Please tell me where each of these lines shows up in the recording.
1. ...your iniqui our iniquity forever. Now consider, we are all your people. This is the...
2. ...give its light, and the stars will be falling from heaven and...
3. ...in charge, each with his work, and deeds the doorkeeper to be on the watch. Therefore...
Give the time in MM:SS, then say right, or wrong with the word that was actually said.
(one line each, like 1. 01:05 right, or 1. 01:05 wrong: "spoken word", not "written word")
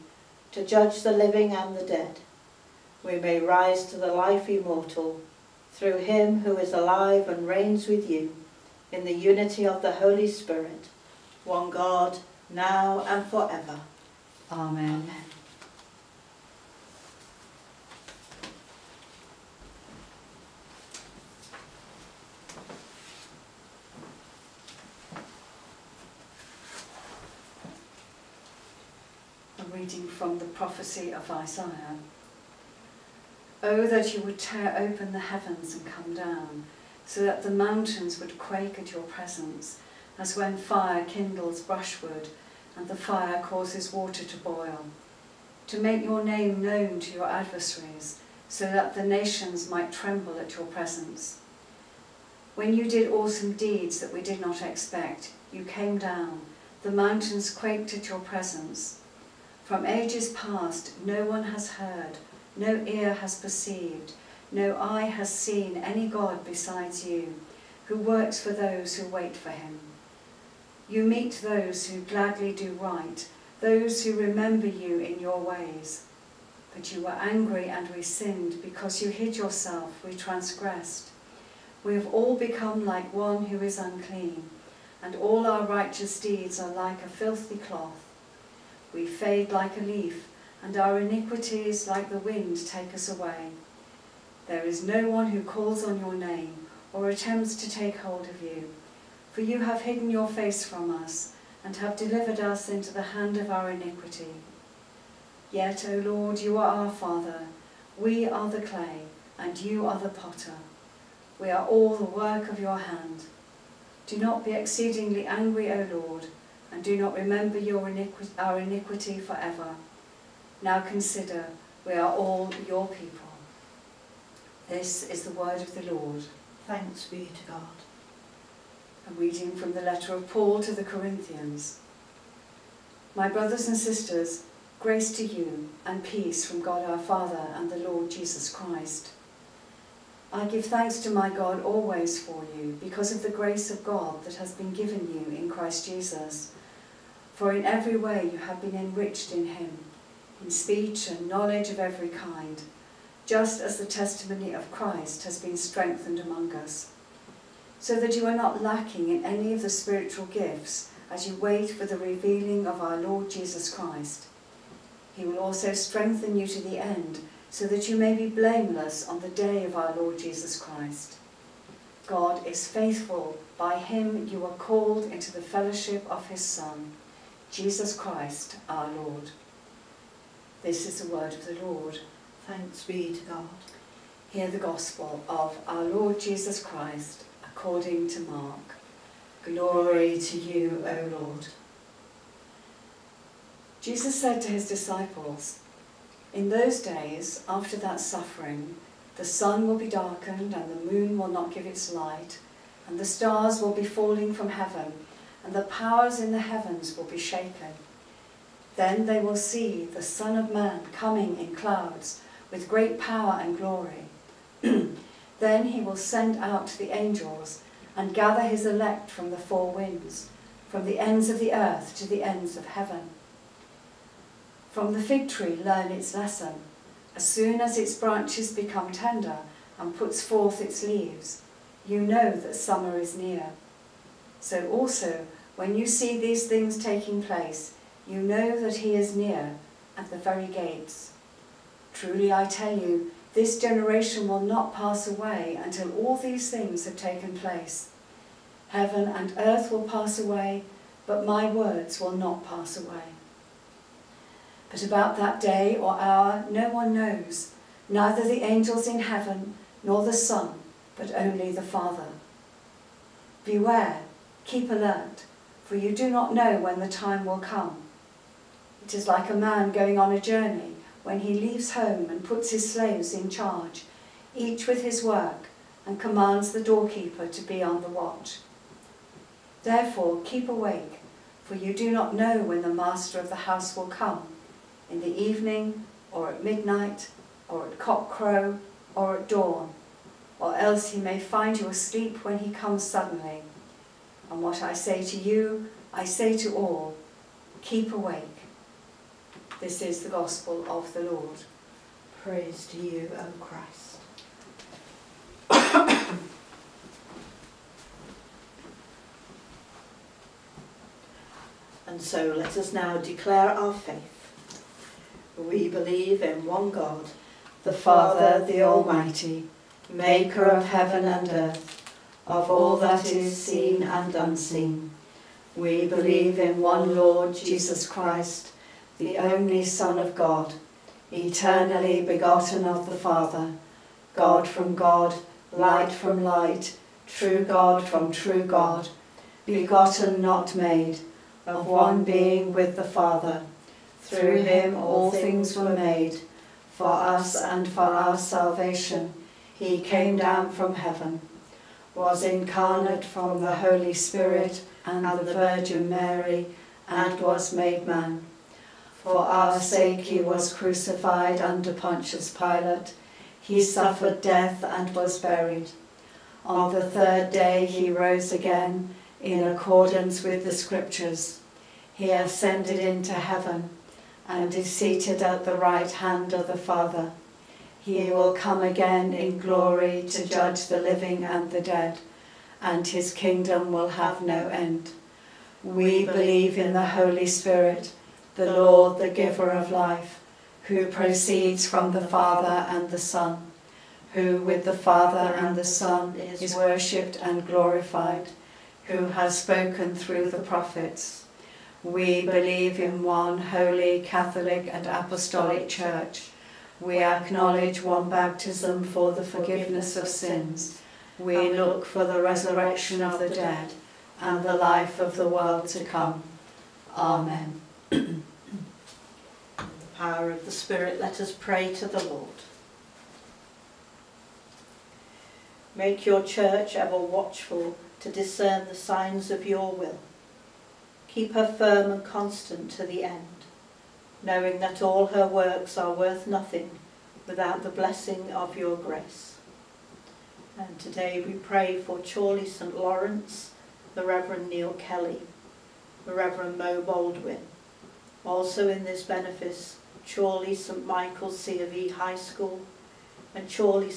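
1. 01:57 right
2. 03:21 right
3. 04:33 wrong: "commands", not "deeds".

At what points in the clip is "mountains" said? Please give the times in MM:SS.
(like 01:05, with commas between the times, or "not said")
00:37, 00:56.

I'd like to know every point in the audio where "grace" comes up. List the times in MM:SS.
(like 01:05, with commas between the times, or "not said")
02:14, 02:23, 07:18.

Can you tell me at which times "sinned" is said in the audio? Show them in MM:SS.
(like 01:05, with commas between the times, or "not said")
01:18.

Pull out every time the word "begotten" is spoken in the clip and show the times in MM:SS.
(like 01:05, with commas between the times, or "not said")
05:32, 05:39.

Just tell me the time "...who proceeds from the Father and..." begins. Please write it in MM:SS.
06:30.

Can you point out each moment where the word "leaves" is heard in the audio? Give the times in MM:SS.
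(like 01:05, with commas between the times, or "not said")
03:50, 04:31.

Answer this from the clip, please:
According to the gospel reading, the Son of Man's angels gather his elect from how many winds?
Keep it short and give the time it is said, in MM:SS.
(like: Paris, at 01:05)
4, at 03:39.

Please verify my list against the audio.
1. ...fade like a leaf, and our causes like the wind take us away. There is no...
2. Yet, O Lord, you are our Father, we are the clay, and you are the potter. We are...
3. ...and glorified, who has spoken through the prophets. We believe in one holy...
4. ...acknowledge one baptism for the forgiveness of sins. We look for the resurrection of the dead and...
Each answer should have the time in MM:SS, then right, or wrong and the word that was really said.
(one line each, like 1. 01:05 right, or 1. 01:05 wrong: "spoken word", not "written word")
1. 01:29 wrong: "iniquities", not "causes"
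2. 01:45 right
3. 06:37 right
4. 06:47 right.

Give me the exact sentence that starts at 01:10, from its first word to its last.
You meet those who gladly do right, those who remember you in your ways.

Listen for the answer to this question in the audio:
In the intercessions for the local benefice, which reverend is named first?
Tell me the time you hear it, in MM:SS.
07:24.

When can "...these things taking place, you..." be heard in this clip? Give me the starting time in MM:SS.
03:56.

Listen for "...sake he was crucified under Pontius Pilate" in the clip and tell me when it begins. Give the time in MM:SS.
05:59.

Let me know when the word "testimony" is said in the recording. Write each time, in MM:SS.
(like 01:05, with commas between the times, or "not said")
02:33.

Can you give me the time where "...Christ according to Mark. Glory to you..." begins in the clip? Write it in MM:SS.
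03:06.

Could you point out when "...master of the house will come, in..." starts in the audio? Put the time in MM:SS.
04:42.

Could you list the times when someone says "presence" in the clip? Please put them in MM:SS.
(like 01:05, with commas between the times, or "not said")
00:39, 00:50, 00:58.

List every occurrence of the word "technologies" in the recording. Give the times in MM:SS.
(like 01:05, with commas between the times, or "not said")
not said.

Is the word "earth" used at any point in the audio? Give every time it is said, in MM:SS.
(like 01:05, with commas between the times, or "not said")
03:41, 04:09, 05:21.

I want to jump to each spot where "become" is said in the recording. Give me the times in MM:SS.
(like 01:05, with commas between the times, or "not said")
01:22, 03:48.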